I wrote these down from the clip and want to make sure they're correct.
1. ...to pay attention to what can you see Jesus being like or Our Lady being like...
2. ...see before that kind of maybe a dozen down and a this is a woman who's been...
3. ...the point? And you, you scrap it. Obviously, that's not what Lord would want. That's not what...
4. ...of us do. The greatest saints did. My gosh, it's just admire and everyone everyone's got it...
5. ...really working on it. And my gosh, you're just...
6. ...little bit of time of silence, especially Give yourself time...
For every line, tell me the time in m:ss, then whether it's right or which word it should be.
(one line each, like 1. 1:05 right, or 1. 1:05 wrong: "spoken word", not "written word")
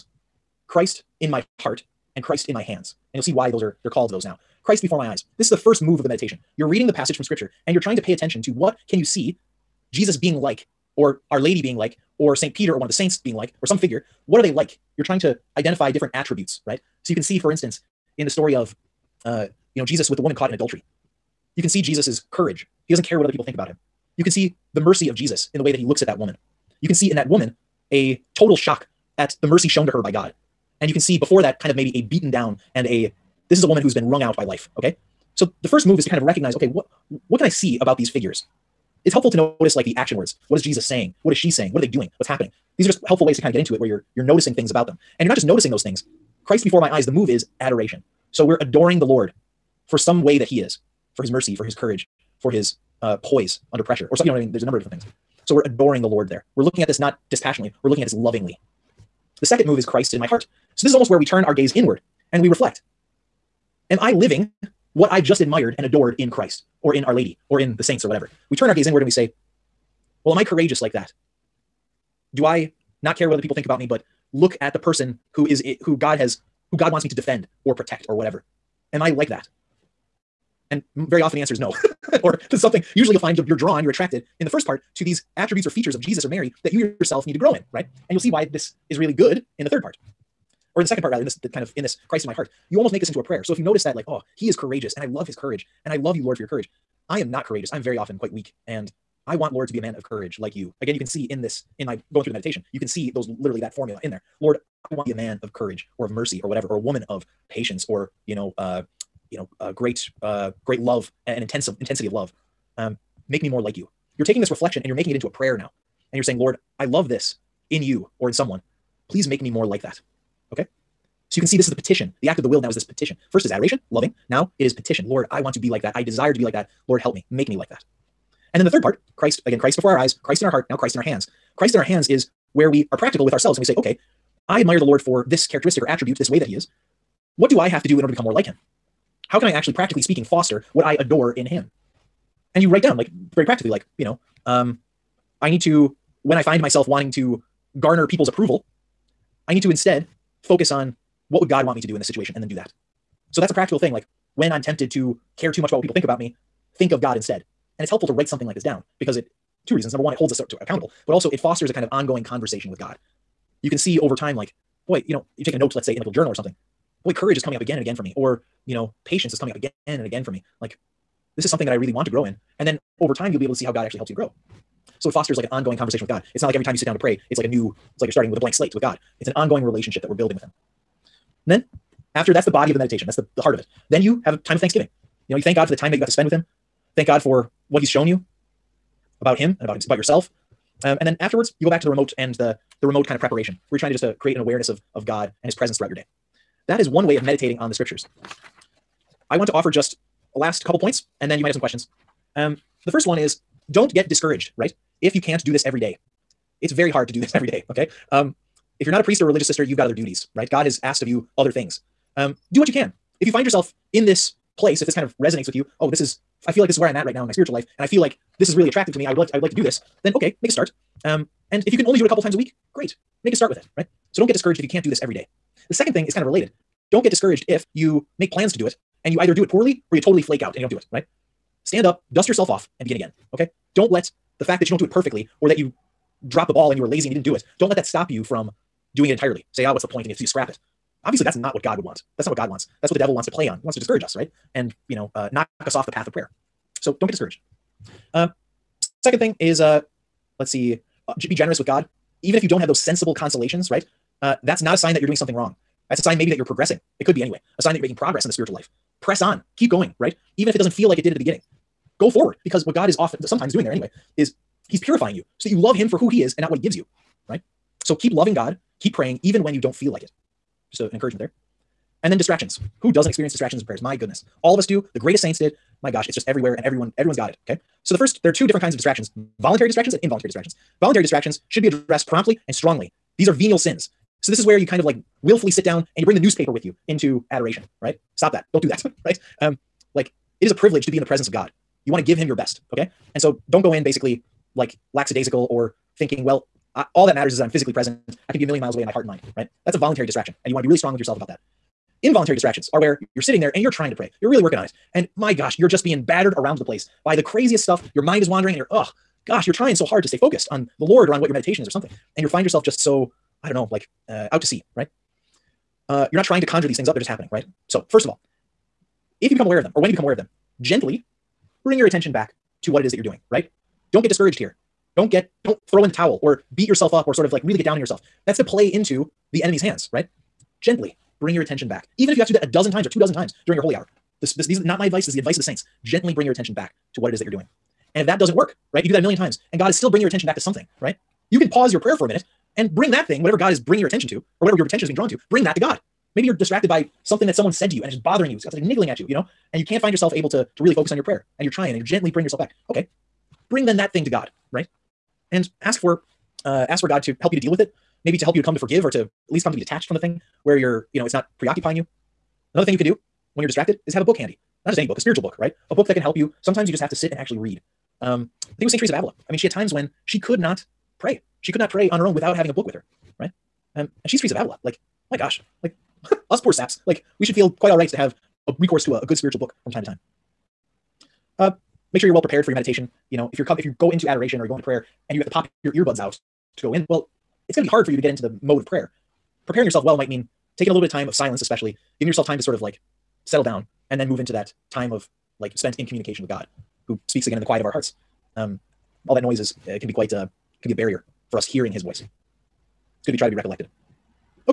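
1. 0:07 right
2. 0:30 wrong: "beaten", not "dozen"
3. 3:59 wrong: "God", not "Lord"
4. 4:34 wrong: "everywhere", not "admire"
5. 5:04 right
6. 6:30 right.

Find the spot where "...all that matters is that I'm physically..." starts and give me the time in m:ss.
4:56.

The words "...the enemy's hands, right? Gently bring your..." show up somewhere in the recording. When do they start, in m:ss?
5:29.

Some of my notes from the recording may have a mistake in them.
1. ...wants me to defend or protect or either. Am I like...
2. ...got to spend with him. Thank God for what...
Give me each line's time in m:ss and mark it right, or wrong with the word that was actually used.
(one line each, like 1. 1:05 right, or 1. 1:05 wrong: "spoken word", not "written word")
1. 1:16 wrong: "whatever", not "either"
2. 3:05 right.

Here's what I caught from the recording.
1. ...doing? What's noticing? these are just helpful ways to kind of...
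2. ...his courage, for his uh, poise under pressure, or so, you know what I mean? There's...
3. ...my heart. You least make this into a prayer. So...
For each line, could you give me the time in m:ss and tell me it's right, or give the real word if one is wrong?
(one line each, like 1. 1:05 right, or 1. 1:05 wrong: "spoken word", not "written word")
1. 0:41 wrong: "happening", not "noticing"
2. 0:51 right
3. 1:32 wrong: "almost", not "least".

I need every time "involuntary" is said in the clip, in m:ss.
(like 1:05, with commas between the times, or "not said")
4:40, 5:02.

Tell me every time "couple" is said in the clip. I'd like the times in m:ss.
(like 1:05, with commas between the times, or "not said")
3:20, 3:42.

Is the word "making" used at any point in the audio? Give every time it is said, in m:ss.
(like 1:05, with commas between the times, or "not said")
1:54, 4:17.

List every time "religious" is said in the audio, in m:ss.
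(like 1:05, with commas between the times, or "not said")
3:29.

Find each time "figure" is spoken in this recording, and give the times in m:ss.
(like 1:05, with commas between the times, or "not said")
0:13, 0:38.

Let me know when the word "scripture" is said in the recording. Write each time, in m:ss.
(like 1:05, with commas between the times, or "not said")
0:07, 3:17.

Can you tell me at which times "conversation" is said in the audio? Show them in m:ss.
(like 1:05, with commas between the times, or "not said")
2:42, 2:55.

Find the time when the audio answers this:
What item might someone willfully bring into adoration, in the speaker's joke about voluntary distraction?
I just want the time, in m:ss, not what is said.
4:46.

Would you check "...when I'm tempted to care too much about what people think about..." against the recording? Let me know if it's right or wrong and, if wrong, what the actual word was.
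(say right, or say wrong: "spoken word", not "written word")
right.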